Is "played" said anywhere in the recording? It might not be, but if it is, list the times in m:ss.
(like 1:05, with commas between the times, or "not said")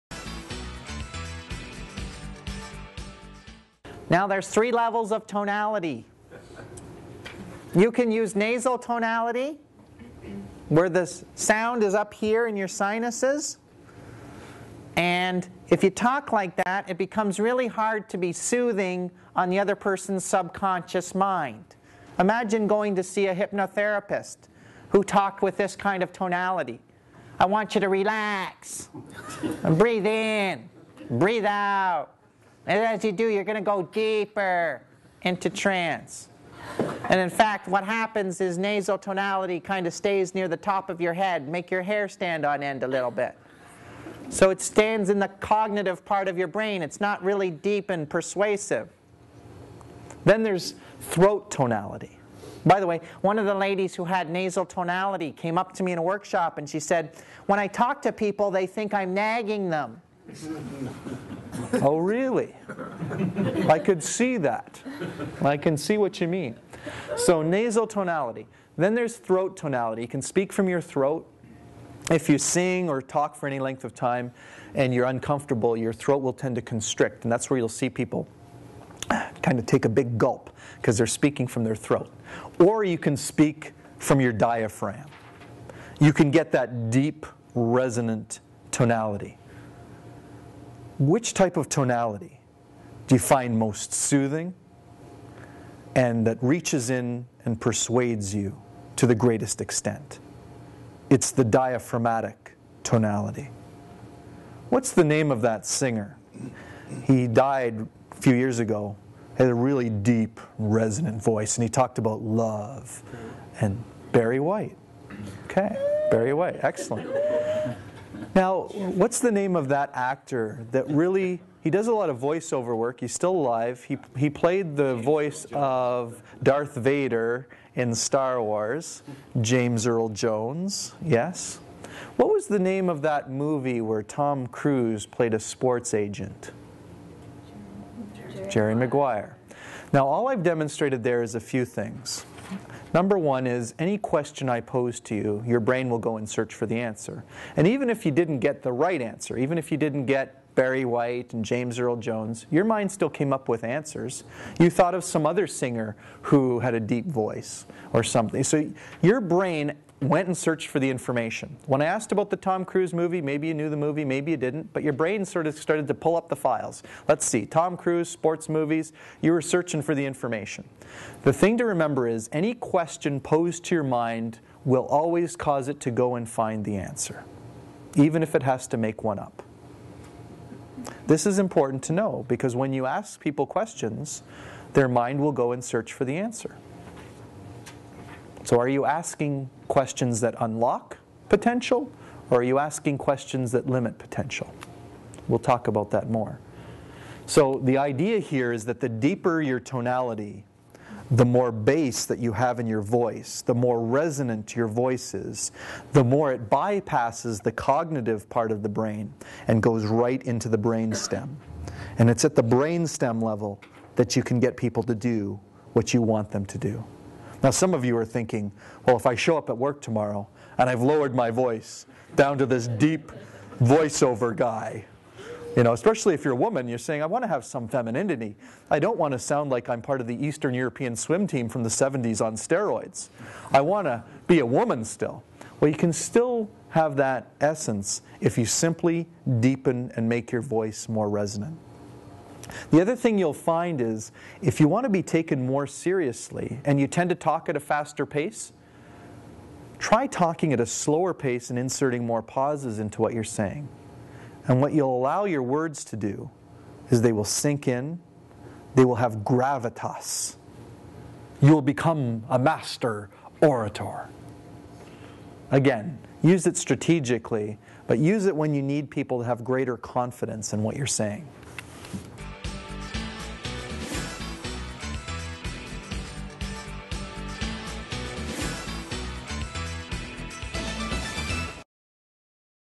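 2:04, 2:15.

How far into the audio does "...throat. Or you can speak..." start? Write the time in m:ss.
1:21.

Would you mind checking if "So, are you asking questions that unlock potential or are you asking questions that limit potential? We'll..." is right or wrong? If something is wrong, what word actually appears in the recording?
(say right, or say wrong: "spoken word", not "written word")
right.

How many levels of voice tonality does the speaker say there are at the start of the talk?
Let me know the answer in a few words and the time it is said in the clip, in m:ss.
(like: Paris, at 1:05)
3, at 0:04.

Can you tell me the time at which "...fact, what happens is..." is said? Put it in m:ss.
0:37.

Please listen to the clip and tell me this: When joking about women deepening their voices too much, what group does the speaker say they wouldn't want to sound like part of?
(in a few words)
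Eastern European swim team.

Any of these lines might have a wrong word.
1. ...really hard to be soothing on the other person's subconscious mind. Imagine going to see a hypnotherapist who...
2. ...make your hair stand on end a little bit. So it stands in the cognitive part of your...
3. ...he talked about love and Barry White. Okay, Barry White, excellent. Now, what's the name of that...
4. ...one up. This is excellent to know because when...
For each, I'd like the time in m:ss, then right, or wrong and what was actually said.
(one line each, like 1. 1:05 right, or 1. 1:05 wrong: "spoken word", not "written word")
1. 0:17 right
2. 0:41 right
3. 1:51 right
4. 2:59 wrong: "important", not "excellent".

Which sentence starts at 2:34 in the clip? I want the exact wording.
You thought of some other singer who had a deep voice or something.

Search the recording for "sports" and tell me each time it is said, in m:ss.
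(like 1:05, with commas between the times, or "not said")
2:15, 2:48.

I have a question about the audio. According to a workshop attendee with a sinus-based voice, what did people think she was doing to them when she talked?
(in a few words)
Nagging them.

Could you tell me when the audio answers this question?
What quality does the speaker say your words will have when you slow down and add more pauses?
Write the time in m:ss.
4:19.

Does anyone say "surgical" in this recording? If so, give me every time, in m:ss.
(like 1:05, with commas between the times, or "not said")
not said.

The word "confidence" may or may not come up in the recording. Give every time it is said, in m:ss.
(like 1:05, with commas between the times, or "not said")
4:29.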